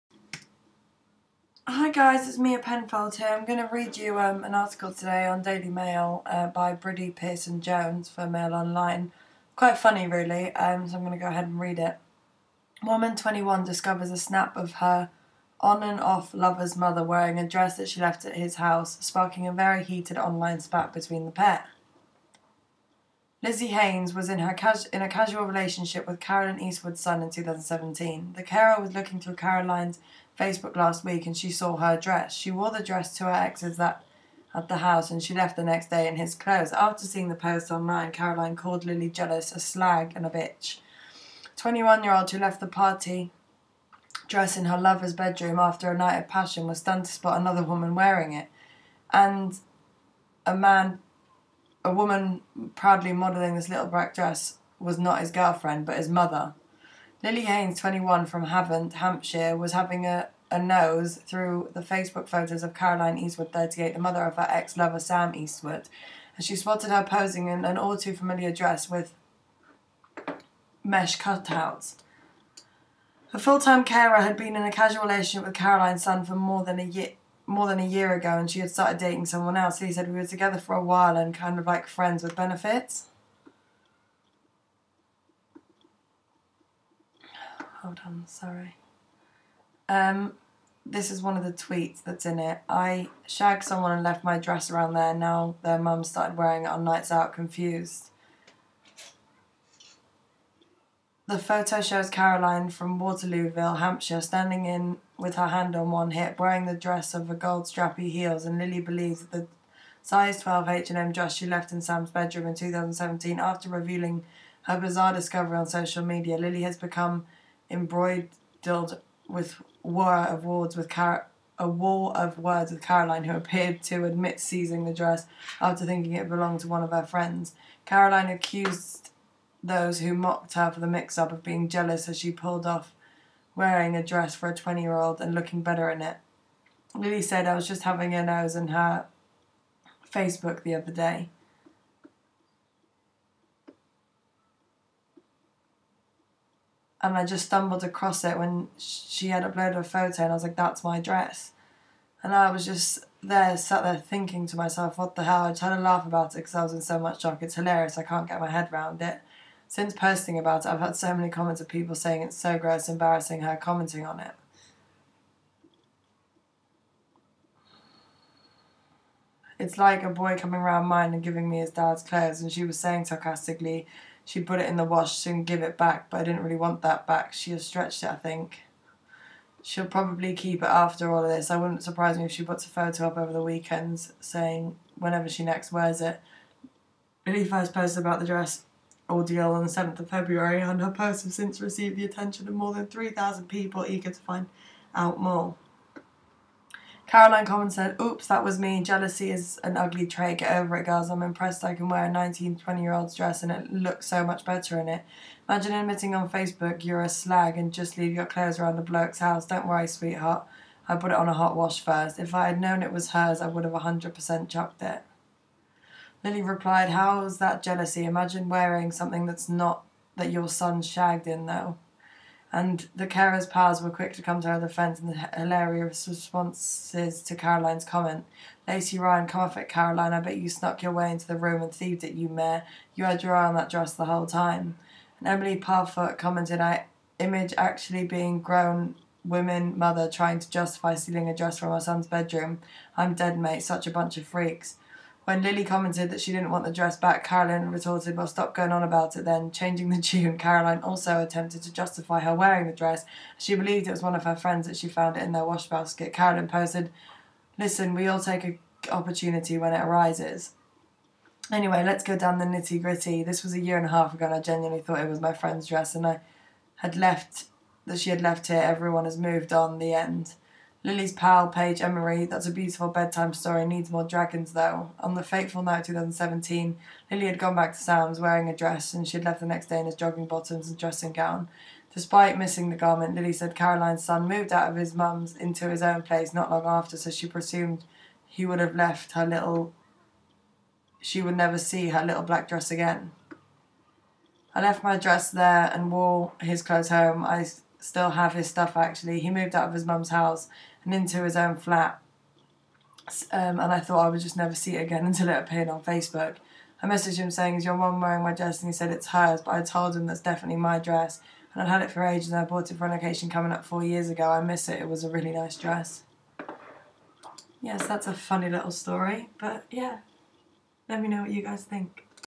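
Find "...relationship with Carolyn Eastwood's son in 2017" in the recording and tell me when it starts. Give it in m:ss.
0:25.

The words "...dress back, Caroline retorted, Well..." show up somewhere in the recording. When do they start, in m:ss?
4:06.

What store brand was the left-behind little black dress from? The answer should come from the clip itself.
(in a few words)
H&M.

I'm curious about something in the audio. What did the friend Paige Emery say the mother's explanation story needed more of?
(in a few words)
Dragons.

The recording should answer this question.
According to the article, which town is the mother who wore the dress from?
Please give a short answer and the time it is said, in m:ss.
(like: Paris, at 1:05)
Waterlooville, at 1:42.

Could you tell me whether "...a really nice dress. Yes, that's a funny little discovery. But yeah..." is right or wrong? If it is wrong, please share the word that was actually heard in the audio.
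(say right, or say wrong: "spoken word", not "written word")
wrong: "story", not "discovery".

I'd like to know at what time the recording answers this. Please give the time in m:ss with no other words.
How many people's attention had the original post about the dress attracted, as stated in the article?
3:12.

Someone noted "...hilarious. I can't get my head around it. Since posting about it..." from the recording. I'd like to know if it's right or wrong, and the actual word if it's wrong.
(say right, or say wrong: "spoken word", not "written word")
right.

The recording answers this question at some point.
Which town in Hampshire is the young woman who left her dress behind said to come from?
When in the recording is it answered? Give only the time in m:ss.
0:58.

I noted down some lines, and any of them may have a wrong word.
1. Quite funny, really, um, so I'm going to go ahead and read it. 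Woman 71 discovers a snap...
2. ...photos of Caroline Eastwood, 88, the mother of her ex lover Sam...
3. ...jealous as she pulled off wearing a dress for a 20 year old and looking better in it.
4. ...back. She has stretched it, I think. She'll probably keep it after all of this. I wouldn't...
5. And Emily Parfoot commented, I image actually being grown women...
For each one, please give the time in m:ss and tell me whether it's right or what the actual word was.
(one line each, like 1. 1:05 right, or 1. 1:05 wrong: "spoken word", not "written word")
1. 0:09 wrong: "21", not "71"
2. 1:02 wrong: "38", not "88"
3. 2:11 right
4. 2:57 right
5. 3:55 right.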